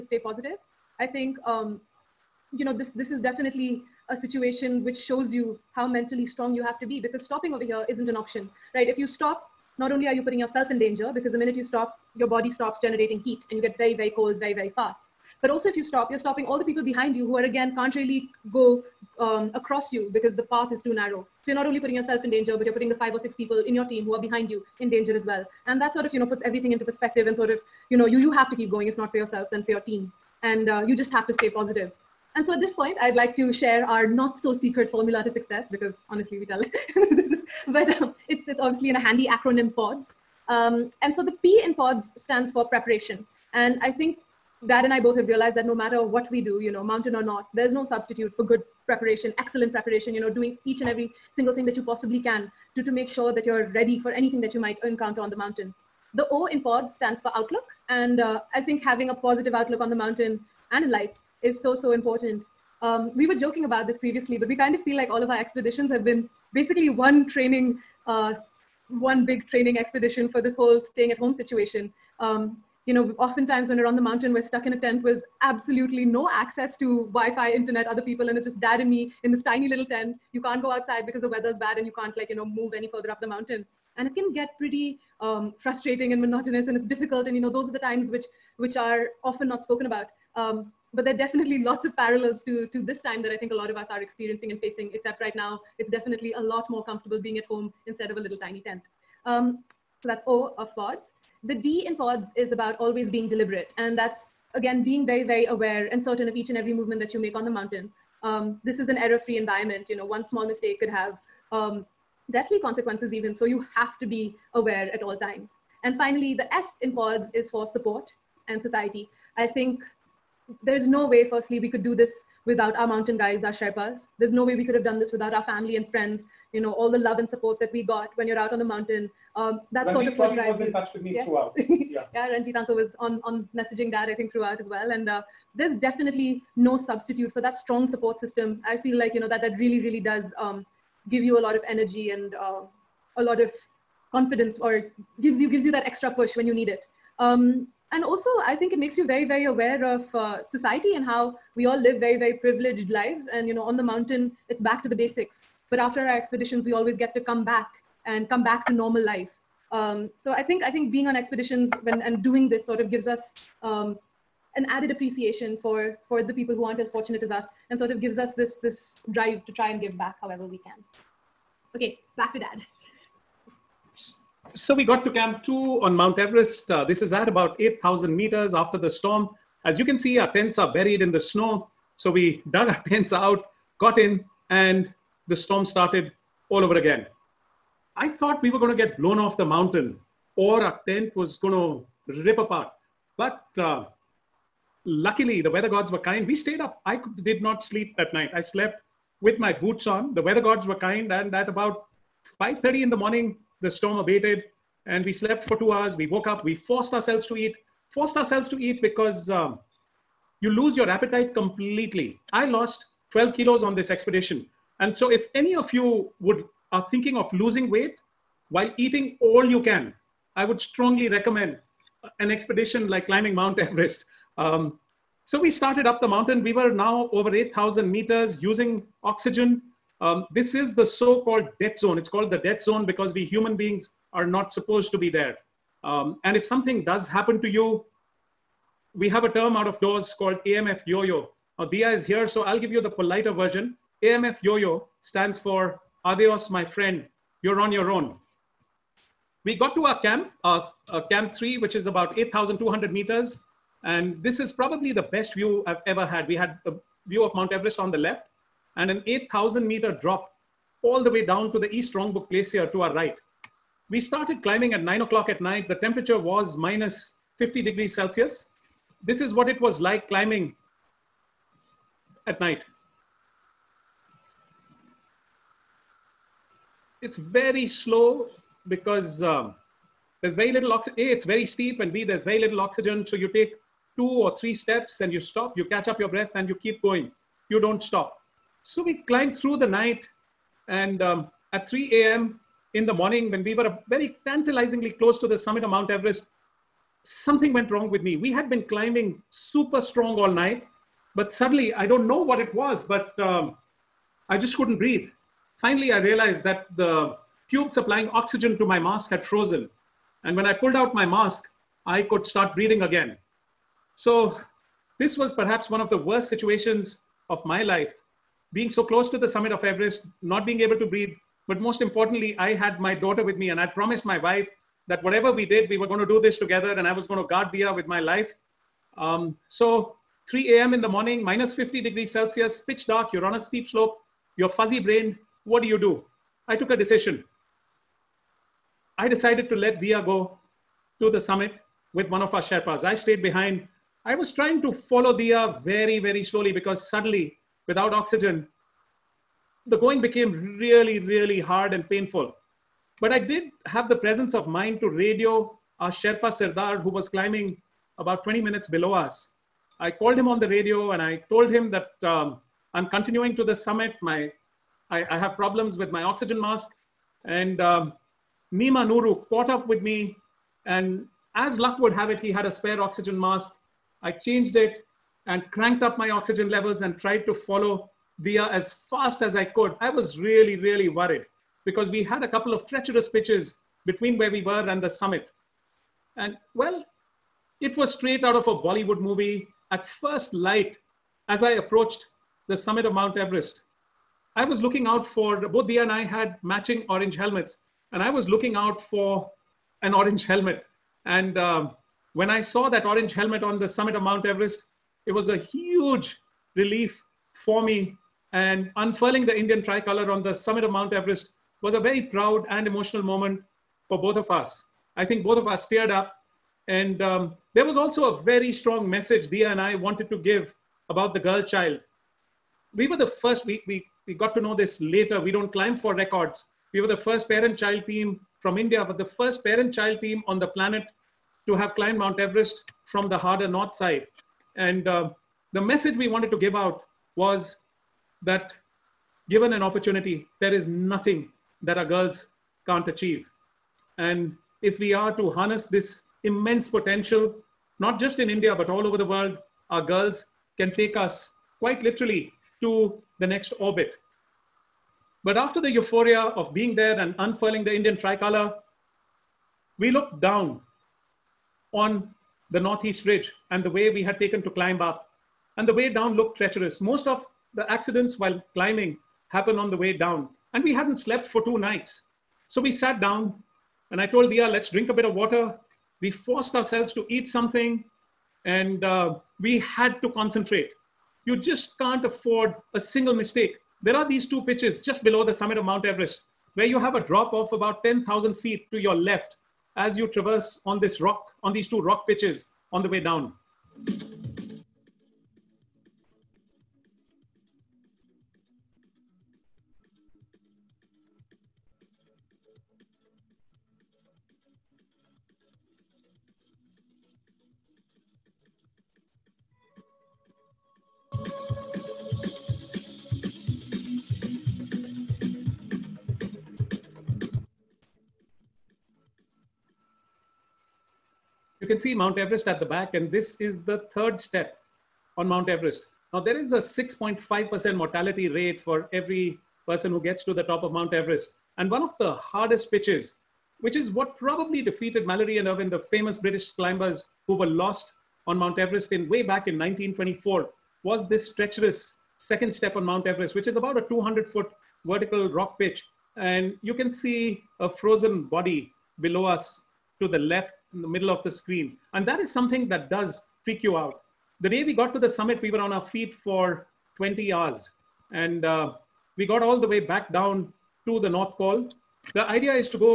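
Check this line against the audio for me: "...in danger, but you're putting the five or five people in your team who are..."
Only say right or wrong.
wrong.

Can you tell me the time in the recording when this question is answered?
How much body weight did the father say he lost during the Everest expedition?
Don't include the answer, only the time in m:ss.
3:33.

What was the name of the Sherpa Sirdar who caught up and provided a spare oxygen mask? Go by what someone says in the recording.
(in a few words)
Nima Nuru.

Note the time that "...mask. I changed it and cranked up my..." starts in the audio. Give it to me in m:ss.
6:13.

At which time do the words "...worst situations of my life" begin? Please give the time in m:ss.
5:15.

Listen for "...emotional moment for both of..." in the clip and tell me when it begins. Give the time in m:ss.
6:52.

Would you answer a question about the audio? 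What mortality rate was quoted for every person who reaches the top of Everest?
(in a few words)
6.5%.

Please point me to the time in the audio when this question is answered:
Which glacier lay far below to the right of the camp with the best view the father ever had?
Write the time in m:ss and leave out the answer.
4:21.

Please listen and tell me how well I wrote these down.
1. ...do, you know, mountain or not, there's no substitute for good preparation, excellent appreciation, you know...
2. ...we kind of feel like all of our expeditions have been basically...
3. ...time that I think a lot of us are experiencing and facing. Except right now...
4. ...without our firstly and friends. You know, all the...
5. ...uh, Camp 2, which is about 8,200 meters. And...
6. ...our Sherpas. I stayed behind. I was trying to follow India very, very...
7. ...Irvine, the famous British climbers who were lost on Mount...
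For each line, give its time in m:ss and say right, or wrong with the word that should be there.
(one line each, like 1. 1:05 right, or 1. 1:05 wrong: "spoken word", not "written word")
1. 0:46 wrong: "preparation", not "appreciation"
2. 1:04 right
3. 1:33 right
4. 2:05 wrong: "family", not "firstly"
5. 4:10 wrong: "3", not "2"
6. 5:42 wrong: "Deeya", not "India"
7. 8:55 right.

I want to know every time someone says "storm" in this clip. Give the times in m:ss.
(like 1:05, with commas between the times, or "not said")
2:58, 3:05, 3:23.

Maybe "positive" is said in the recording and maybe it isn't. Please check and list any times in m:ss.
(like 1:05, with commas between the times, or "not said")
0:00, 0:31, 0:59.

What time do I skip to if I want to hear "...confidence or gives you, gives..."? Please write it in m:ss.
2:24.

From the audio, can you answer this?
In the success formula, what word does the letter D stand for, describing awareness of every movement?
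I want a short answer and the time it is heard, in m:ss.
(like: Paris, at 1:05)
Deliberate, at 1:43.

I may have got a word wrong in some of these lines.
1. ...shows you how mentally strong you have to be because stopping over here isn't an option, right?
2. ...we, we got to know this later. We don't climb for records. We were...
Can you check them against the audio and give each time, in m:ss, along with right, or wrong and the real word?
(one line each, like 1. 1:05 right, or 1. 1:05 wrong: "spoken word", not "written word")
1. 0:04 right
2. 7:03 right.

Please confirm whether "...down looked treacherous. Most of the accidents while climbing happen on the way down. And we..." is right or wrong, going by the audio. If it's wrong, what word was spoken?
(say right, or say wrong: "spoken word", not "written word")
right.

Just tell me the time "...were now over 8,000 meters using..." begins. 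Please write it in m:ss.
3:46.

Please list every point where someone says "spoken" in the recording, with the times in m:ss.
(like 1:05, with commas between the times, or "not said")
1:29.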